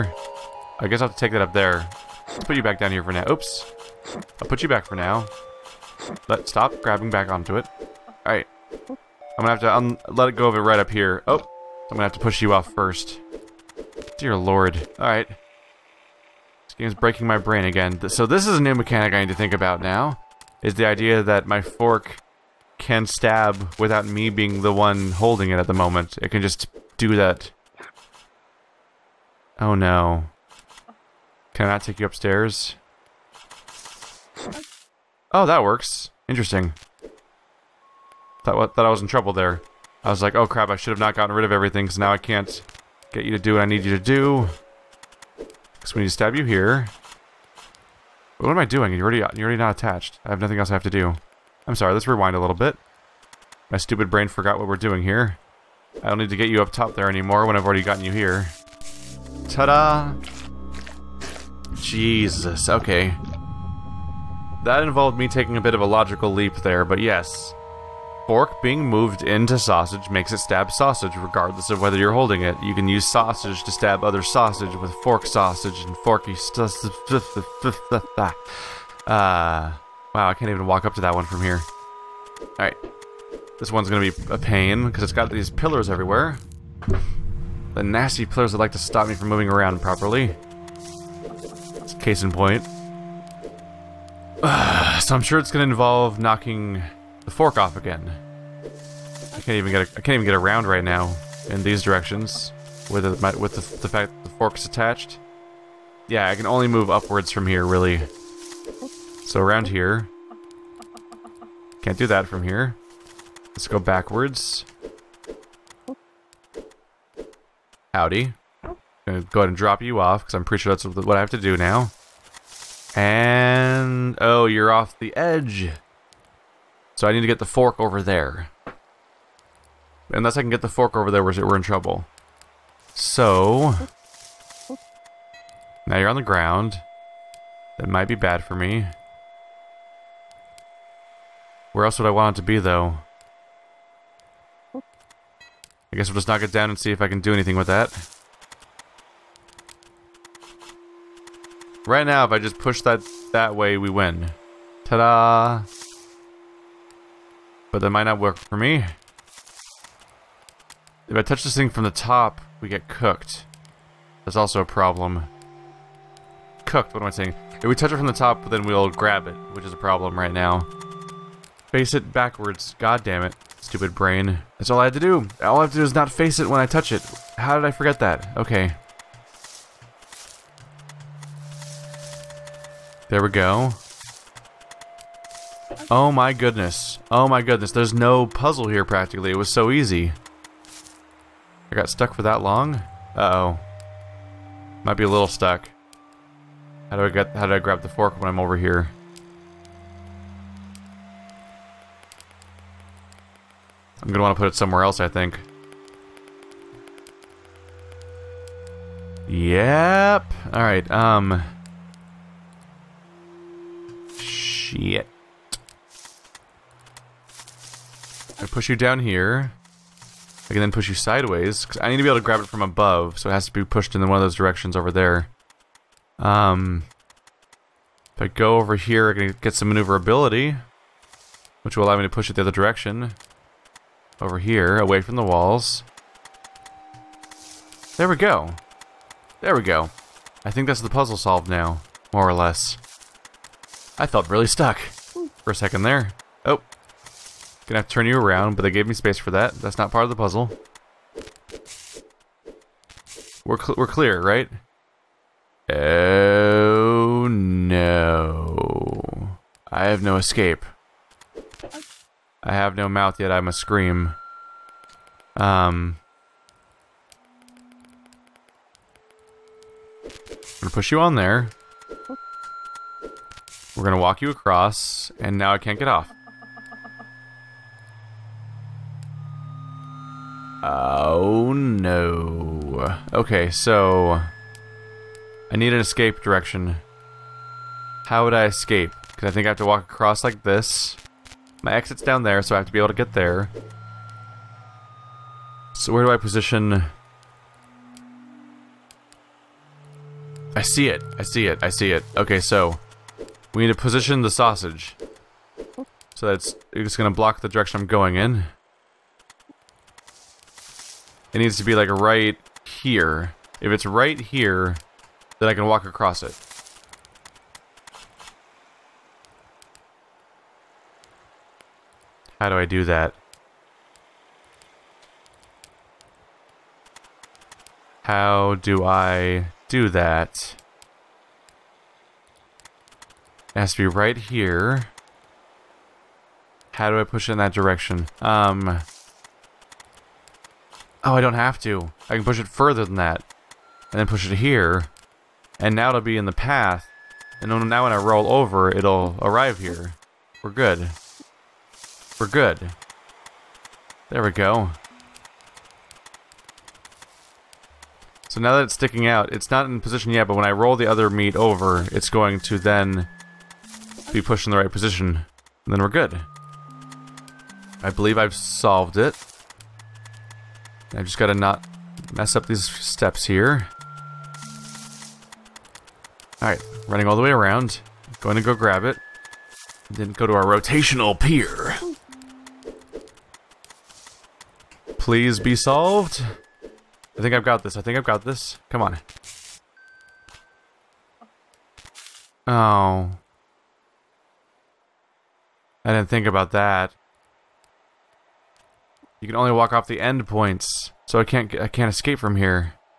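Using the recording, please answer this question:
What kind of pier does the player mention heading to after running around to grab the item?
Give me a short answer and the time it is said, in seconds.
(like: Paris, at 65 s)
rotational pier, at 380 s.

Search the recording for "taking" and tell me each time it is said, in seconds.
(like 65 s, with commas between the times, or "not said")
65 s.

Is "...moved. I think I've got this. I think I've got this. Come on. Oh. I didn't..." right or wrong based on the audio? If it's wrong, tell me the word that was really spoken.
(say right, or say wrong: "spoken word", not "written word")
wrong: "solved", not "moved".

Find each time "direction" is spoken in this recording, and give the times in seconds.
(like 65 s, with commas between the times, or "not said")
101 s, 224 s, 232 s, 286 s, 307 s, 337 s.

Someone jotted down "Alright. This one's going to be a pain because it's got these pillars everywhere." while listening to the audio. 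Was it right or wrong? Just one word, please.
right.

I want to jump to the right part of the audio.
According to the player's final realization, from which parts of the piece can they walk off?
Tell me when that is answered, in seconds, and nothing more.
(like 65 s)
399 s.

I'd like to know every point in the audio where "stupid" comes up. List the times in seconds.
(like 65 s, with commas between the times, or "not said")
53 s, 173 s.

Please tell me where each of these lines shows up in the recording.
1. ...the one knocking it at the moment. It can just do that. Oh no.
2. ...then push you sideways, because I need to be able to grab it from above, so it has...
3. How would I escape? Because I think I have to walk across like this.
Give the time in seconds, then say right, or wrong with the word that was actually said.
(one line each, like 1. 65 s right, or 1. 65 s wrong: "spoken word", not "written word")
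1. 24 s wrong: "holding", not "knocking"
2. 220 s right
3. 288 s right.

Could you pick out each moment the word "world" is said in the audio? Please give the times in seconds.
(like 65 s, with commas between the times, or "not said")
not said.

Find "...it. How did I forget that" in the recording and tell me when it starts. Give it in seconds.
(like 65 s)
176 s.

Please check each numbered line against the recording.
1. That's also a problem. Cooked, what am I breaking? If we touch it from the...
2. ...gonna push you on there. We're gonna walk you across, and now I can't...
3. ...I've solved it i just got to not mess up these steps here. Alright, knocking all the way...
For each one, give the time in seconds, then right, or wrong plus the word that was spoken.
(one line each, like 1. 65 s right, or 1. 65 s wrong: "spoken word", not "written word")
1. 164 s wrong: "saying", not "breaking"
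2. 270 s right
3. 368 s wrong: "running", not "knocking".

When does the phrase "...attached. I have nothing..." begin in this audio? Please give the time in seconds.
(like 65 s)
49 s.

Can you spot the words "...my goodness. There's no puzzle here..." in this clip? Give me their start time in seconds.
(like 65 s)
187 s.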